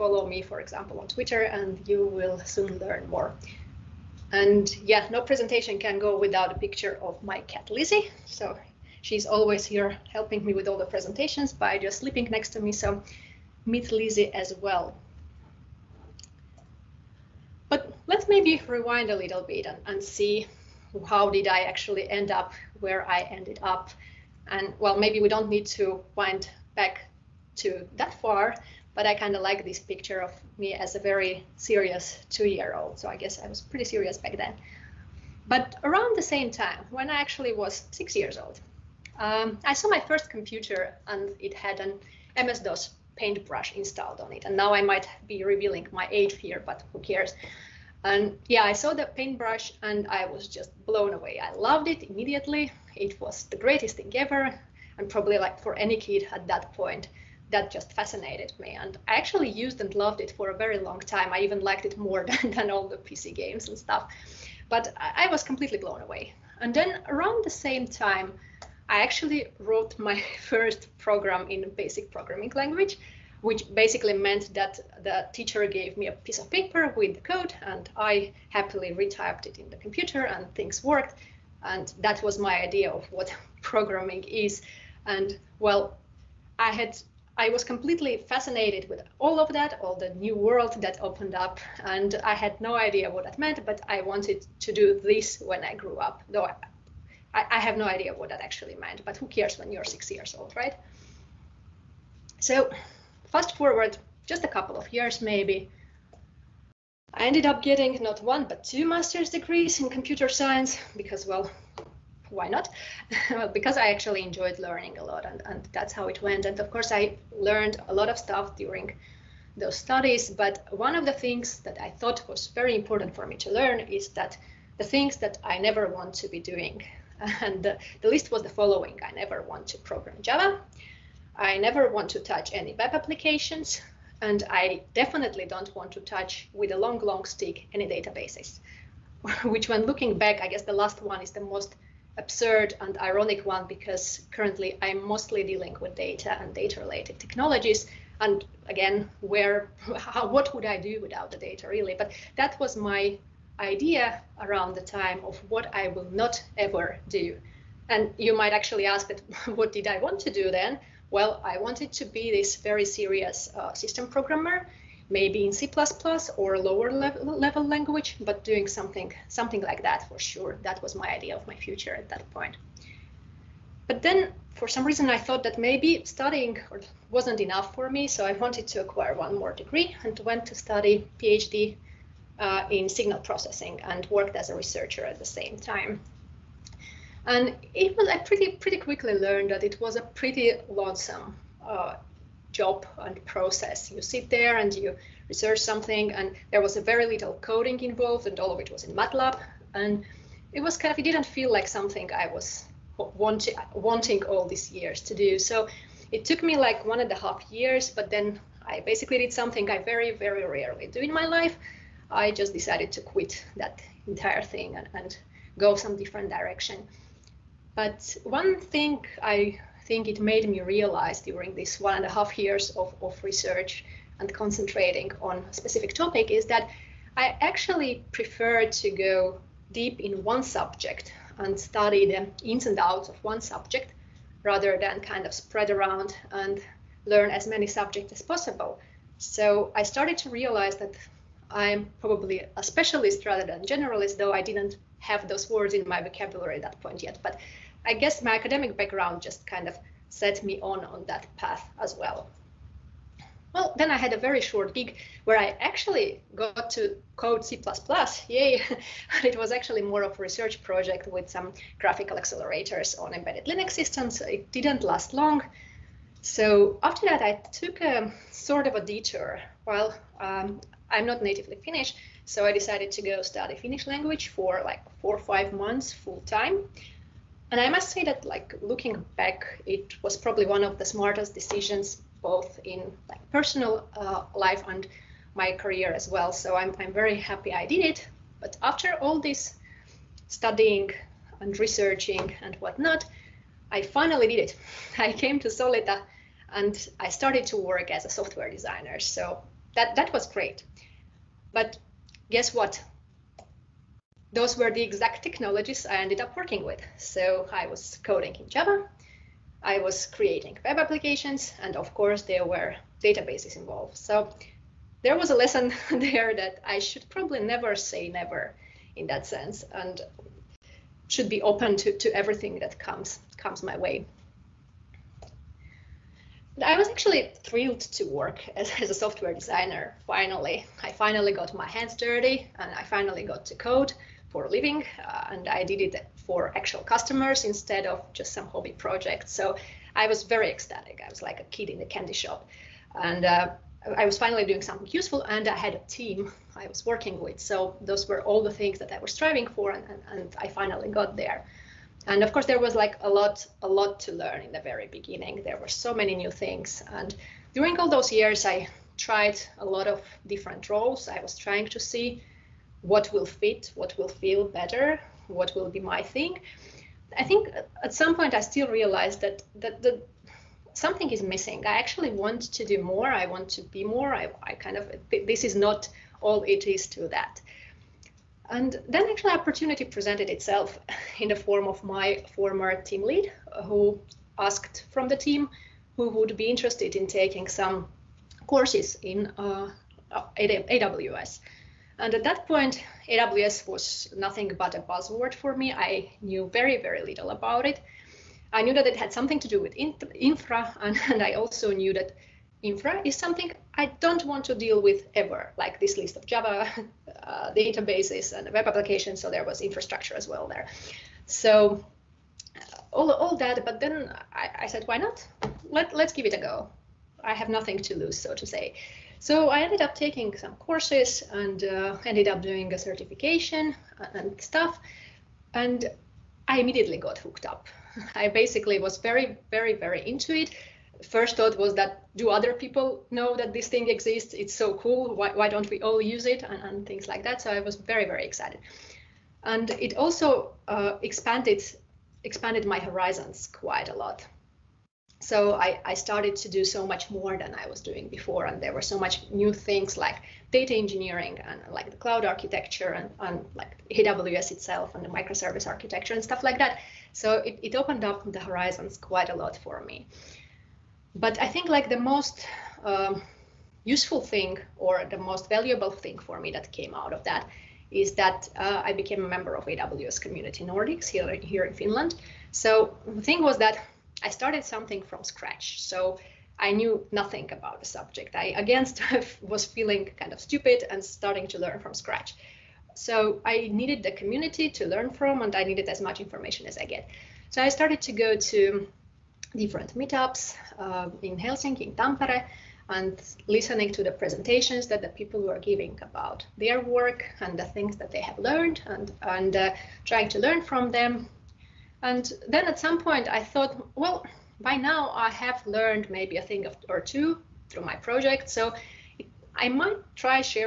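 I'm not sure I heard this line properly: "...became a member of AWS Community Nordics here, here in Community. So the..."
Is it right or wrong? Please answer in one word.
wrong.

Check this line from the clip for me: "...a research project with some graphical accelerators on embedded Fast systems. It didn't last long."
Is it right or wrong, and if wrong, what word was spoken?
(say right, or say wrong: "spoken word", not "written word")
wrong: "Linux", not "Fast".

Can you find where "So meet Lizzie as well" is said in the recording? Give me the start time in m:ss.
0:12.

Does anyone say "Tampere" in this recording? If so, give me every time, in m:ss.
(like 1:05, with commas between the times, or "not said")
8:11.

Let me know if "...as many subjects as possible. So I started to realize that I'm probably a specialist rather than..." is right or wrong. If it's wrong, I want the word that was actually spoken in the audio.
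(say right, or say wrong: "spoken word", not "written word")
right.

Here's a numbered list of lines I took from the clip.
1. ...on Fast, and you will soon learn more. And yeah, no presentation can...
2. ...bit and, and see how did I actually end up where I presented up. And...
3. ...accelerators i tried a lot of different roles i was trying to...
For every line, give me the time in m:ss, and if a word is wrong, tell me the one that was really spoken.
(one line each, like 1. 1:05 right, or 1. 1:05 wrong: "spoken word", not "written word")
1. 0:00 wrong: "Twitter", not "Fast"
2. 0:19 wrong: "ended", not "presented"
3. 5:58 wrong: "years", not "accelerators".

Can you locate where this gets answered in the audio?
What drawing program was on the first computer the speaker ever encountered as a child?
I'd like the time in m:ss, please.
0:42.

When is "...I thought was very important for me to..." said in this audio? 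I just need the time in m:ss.
2:01.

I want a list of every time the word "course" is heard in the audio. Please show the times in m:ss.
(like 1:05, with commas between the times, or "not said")
1:56, 5:11, 5:52, 6:28, 7:00.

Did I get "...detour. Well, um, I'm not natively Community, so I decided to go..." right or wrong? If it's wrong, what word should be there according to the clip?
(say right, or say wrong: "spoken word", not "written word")
wrong: "Finnish", not "Community".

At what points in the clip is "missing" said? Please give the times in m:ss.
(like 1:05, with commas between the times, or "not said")
6:11.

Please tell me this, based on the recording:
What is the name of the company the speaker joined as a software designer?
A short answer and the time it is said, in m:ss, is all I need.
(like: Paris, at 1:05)
Solita, at 4:55.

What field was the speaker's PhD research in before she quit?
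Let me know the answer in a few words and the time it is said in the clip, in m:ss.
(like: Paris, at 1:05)
Signal processing, at 3:02.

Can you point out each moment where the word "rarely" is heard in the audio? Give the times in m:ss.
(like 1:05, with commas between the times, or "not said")
3:30.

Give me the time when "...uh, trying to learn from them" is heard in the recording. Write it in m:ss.
8:19.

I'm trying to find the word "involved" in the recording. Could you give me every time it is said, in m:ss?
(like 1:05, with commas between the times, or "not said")
3:17, 5:13.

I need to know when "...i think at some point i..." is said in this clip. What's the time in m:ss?
6:07.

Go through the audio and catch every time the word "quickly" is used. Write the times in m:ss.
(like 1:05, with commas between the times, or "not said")
3:08.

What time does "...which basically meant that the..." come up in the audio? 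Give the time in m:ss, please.
1:13.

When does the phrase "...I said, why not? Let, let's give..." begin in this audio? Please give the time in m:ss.
6:54.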